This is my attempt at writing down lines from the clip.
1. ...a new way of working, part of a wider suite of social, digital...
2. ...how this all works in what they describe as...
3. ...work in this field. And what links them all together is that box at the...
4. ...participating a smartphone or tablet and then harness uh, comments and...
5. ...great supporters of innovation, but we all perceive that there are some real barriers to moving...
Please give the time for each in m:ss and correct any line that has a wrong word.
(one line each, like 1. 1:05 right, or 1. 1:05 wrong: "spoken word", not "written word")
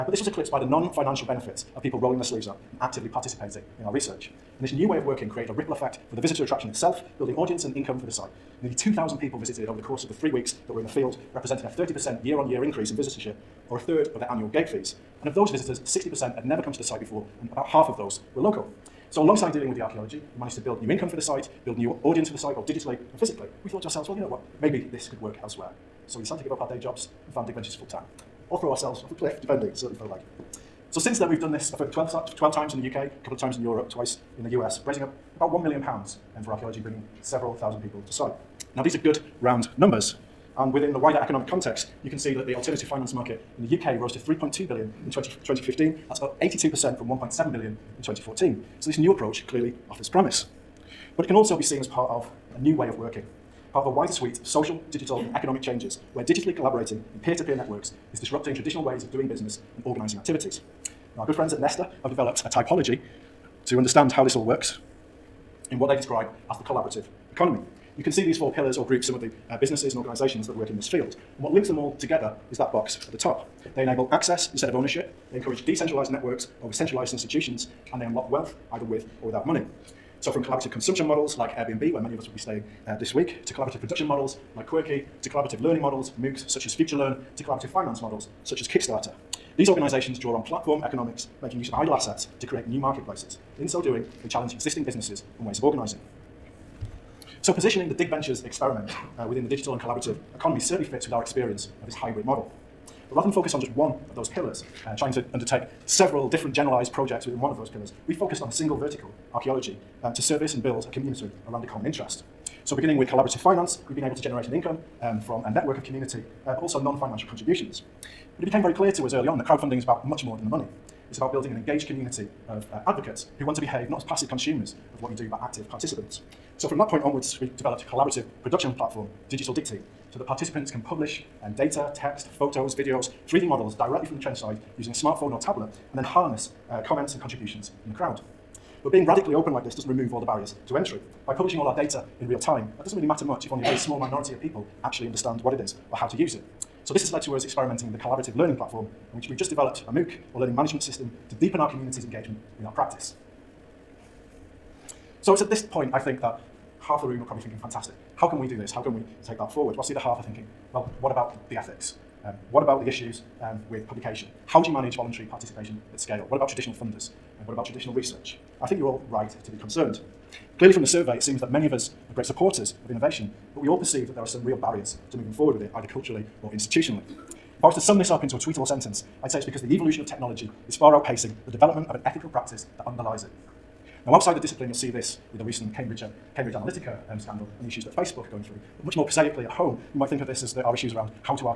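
1. 0:52 right
2. 1:04 right
3. 1:10 right
4. 2:14 wrong: "using", not "participating"
5. 2:52 right.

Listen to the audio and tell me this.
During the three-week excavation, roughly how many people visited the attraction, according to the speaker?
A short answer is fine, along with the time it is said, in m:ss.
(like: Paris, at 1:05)
Nearly 2,000, at 0:08.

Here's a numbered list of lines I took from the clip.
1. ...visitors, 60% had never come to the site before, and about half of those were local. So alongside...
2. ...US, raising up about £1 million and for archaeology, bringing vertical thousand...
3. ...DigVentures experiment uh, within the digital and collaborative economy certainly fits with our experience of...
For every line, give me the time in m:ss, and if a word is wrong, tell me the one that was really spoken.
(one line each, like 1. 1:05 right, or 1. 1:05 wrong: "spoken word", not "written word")
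1. 0:15 right
2. 0:34 wrong: "several", not "vertical"
3. 1:37 right.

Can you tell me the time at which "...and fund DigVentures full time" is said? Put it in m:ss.
0:27.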